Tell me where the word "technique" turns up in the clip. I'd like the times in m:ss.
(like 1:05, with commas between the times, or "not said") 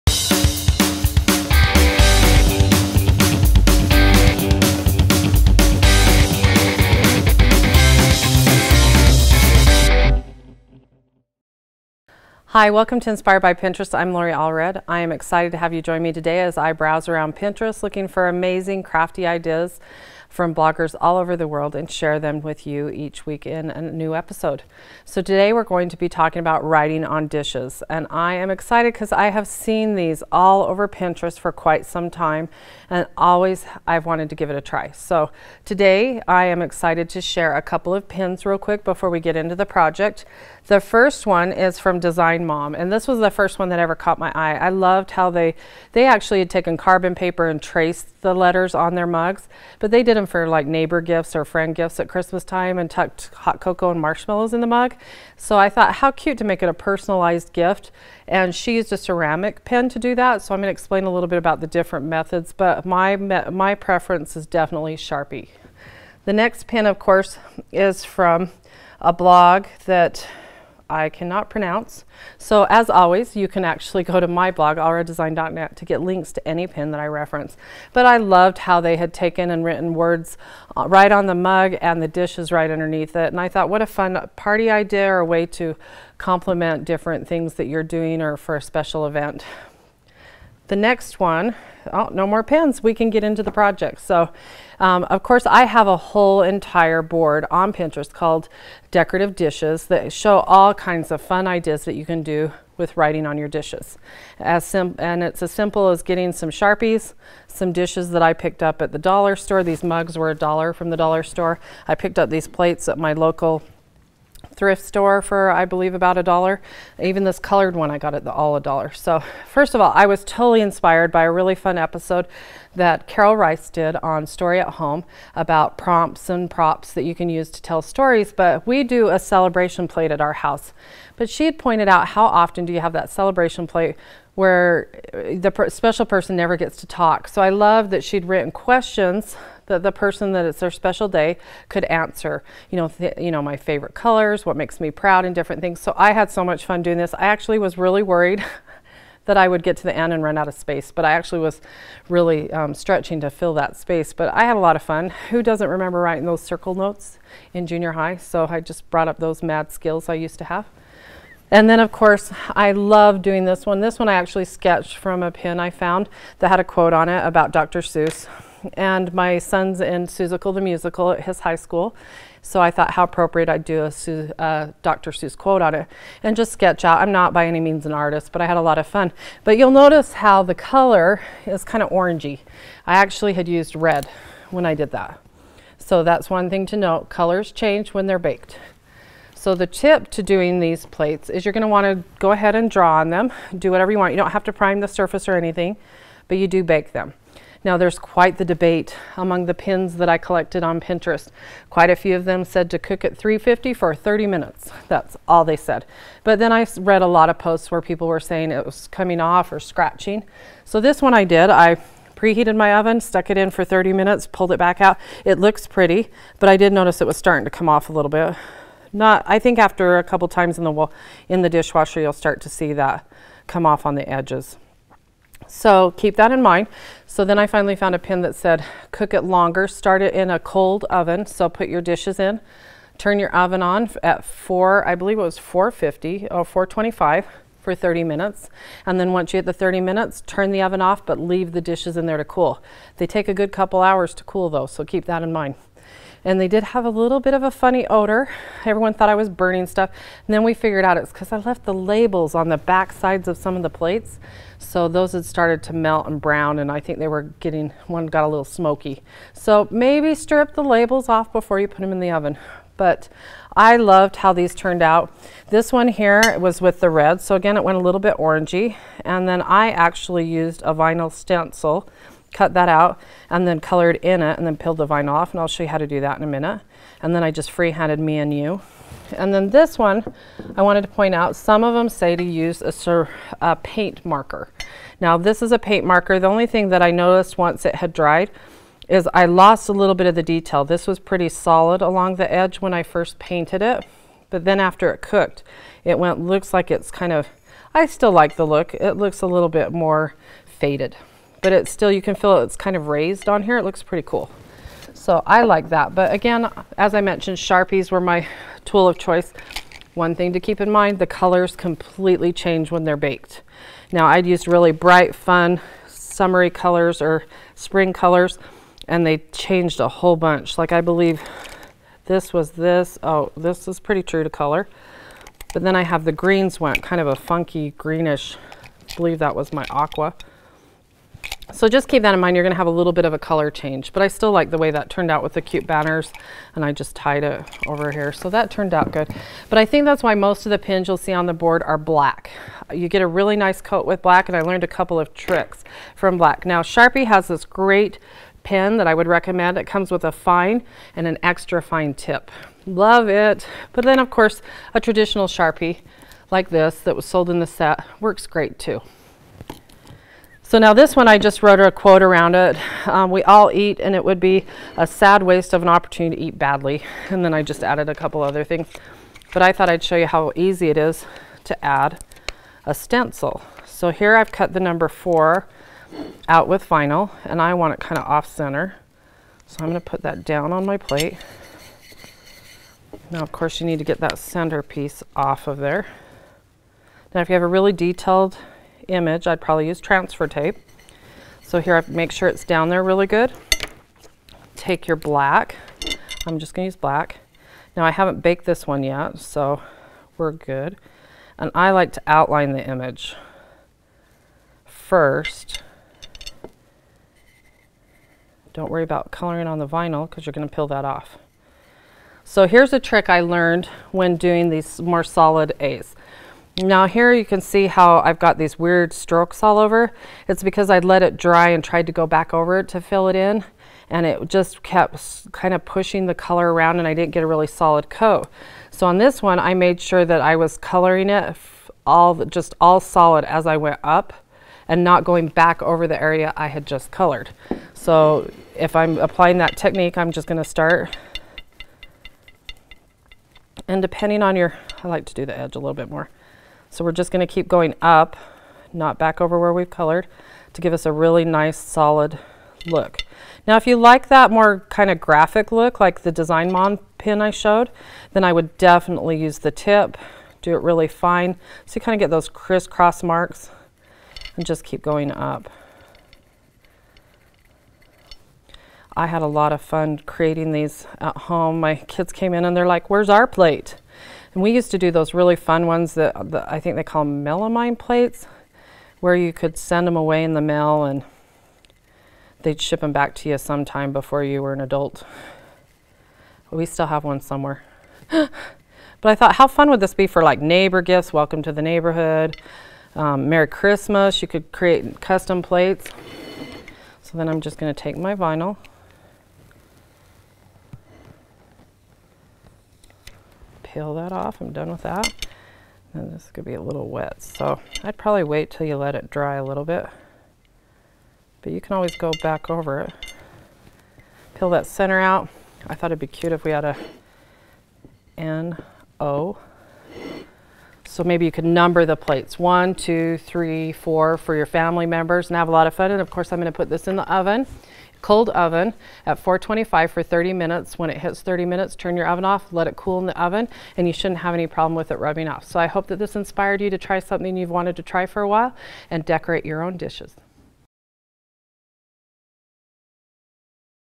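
7:19.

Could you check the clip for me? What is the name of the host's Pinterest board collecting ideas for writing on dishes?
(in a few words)
Decorative Dishes.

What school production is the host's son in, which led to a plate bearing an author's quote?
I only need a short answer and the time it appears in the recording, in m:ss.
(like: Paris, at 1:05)
Seussical the Musical, at 2:50.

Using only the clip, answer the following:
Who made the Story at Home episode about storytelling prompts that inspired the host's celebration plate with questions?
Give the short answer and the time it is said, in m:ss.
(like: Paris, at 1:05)
Carol Rice, at 2:03.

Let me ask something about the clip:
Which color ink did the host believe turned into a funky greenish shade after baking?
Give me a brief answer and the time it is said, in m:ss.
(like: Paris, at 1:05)
aqua, at 5:29.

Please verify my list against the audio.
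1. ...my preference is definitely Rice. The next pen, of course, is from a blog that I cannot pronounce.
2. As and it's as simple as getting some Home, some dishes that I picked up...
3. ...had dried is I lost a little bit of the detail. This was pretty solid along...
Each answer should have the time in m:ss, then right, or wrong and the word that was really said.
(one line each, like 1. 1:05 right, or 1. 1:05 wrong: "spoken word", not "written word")
1. 1:03 wrong: "Sharpie", not "Rice"
2. 1:44 wrong: "Sharpies", not "Home"
3. 4:47 right.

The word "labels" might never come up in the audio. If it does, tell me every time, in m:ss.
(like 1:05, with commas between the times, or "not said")
4:11, 4:20.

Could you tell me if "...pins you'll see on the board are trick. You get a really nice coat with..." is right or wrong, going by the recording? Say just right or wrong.
wrong.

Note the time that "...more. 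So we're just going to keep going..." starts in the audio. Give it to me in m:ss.
7:25.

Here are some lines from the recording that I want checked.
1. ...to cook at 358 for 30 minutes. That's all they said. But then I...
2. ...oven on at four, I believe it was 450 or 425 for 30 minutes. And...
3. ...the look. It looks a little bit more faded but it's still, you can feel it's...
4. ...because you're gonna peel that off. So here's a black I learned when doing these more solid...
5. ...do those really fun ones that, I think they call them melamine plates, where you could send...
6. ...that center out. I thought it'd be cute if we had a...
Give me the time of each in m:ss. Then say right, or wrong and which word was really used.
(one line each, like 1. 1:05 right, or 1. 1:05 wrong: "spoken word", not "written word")
1. 3:22 wrong: "350", not "358"
2. 3:53 right
3. 4:58 right
4. 6:50 wrong: "trick", not "black"
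5. 7:54 right
6. 8:34 right.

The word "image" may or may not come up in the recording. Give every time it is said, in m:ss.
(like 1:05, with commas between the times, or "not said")
6:28, 6:42.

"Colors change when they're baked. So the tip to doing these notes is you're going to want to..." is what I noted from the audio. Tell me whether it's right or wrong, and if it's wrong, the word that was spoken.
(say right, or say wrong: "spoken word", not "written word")
wrong: "plates", not "notes".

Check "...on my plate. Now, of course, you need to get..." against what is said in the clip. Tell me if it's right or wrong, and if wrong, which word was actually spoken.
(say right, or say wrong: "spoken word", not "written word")
right.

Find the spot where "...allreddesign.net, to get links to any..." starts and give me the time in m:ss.
1:14.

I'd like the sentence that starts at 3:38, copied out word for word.
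Not, I think after a couple times in the, in the dishwasher, you'll start to see that come off on the edges.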